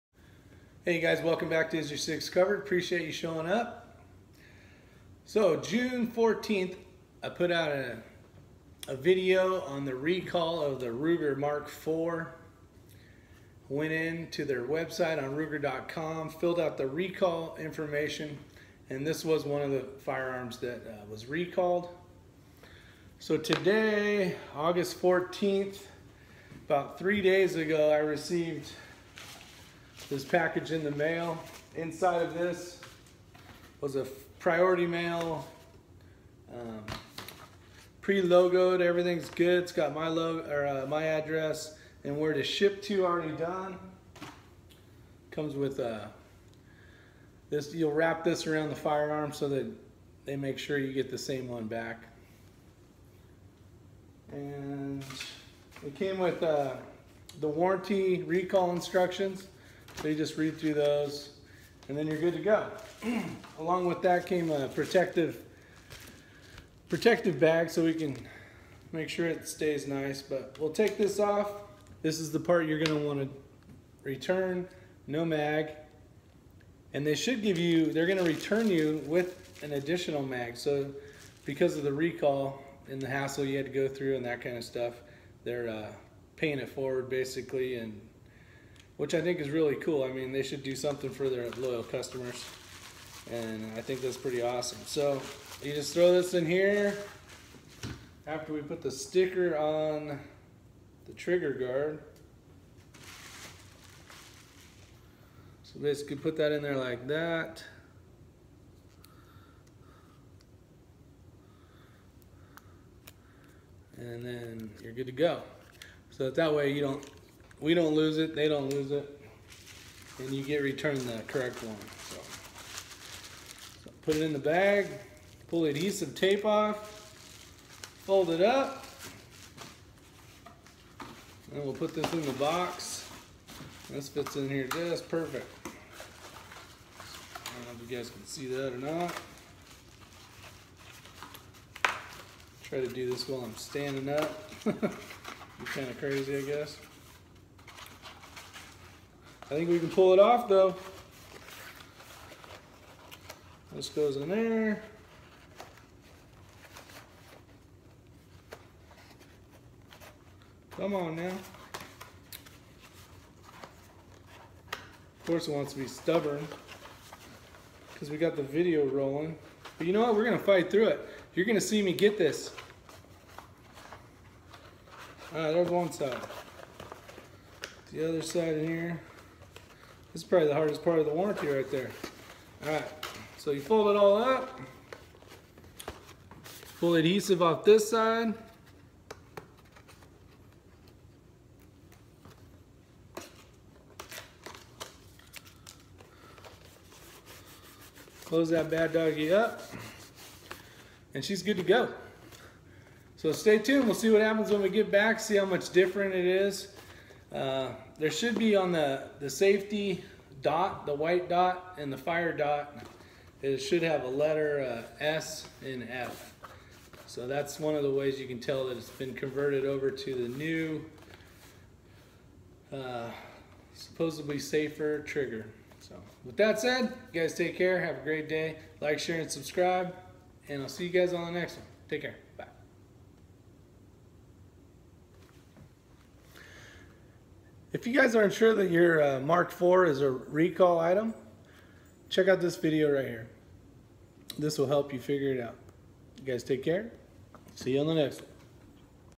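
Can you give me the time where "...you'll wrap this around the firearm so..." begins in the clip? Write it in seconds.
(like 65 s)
47 s.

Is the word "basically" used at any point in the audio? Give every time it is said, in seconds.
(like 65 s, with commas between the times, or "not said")
87 s, 105 s.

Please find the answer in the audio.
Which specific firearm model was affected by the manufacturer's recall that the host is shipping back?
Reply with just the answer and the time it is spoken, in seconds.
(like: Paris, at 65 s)
Ruger Mark IV, at 10 s.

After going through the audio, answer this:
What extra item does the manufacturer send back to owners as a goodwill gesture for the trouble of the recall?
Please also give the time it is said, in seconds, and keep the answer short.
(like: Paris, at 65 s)
An additional mag, at 79 s.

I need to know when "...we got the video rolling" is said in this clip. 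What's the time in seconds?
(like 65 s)
168 s.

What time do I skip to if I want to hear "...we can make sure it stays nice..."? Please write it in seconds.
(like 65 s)
67 s.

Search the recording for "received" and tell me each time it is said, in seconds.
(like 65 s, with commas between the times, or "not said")
27 s.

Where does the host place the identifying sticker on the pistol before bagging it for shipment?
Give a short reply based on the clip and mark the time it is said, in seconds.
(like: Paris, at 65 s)
On the trigger guard, at 101 s.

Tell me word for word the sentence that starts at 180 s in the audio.
This is probably the hardest part of the warranty right there.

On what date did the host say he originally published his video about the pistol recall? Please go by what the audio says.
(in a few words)
June 14th.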